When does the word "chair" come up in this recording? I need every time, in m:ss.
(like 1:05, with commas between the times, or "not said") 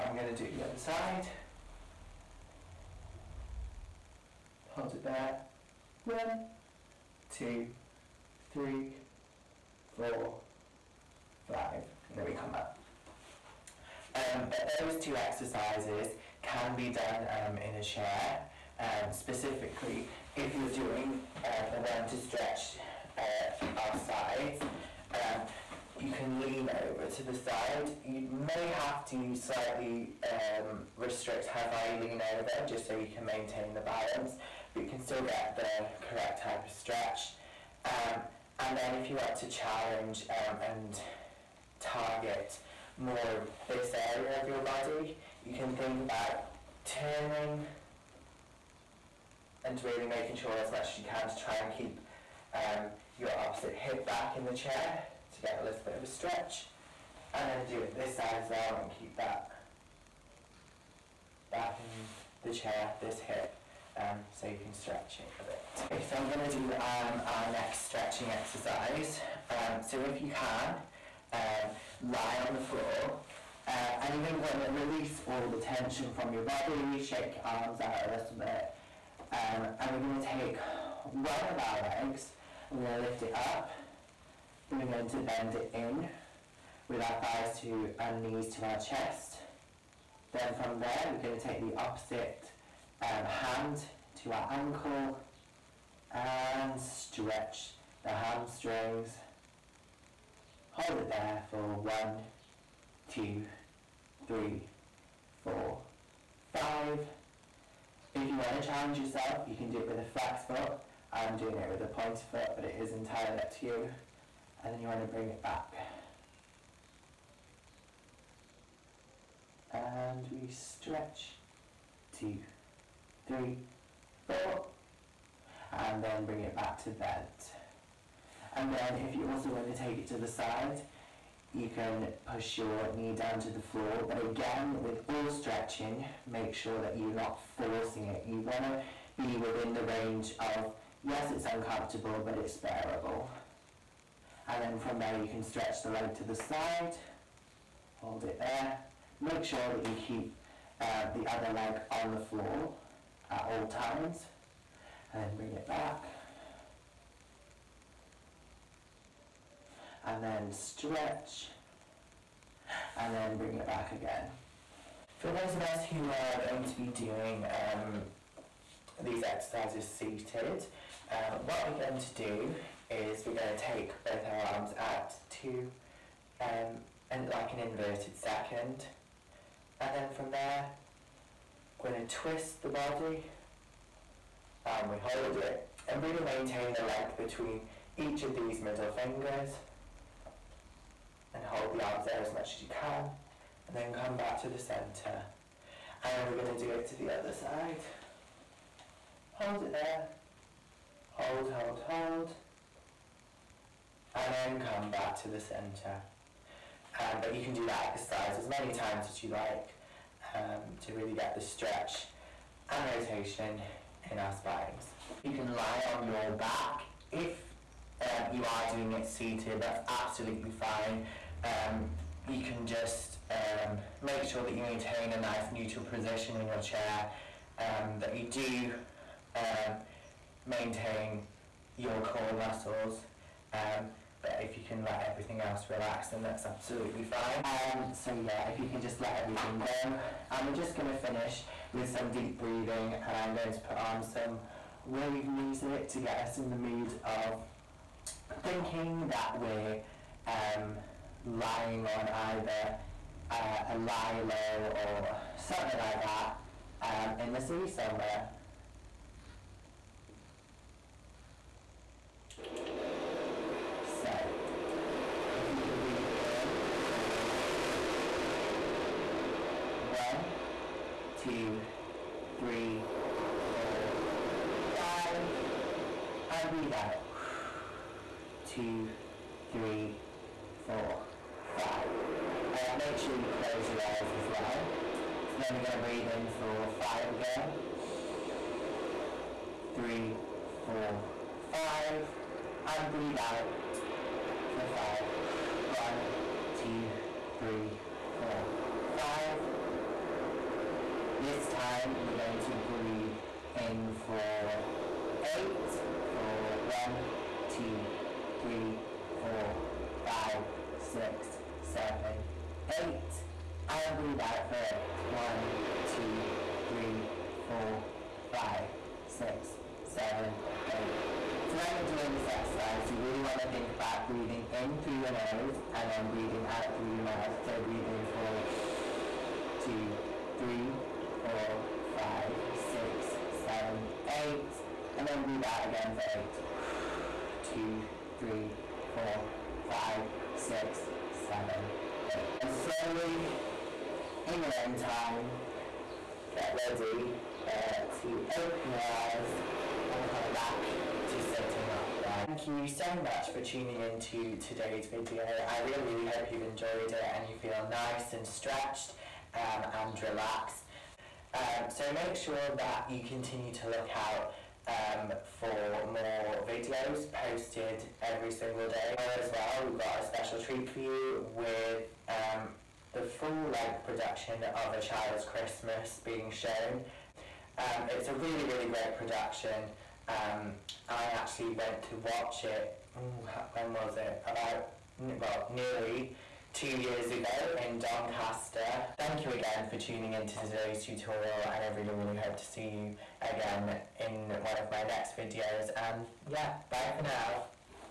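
0:17, 0:54, 1:02, 3:46.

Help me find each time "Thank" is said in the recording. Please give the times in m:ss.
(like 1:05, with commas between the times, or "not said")
5:52, 6:28.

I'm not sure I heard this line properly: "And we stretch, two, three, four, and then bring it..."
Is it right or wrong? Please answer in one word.
right.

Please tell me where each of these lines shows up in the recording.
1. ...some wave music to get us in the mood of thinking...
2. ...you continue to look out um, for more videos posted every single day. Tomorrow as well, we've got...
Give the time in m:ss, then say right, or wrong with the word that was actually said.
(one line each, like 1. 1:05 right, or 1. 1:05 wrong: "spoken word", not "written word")
1. 4:04 right
2. 6:02 right.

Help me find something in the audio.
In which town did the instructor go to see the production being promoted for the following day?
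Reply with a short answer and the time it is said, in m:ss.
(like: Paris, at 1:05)
Doncaster, at 6:27.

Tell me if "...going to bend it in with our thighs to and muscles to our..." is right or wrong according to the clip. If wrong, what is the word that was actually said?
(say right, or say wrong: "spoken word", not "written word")
wrong: "knees", not "muscles".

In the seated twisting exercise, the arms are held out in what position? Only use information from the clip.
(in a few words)
Inverted second.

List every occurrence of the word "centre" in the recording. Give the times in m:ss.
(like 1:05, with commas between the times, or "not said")
3:14, 3:25.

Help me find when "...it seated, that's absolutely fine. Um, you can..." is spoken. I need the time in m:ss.
3:38.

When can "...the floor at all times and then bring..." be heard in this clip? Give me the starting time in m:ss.
2:32.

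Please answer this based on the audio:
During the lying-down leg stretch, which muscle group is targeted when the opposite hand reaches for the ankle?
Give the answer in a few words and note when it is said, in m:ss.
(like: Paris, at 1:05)
Hamstrings, at 1:38.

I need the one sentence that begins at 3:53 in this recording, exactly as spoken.
Um, but if you can let everything else relax then that's absolutely fine.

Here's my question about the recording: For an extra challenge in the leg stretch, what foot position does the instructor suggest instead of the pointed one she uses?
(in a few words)
Flex foot.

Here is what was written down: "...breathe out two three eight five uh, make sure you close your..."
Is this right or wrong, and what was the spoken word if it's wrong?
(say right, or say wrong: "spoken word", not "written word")
wrong: "four", not "eight".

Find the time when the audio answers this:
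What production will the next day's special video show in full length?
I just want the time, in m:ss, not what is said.
6:14.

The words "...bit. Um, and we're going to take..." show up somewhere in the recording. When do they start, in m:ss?
1:18.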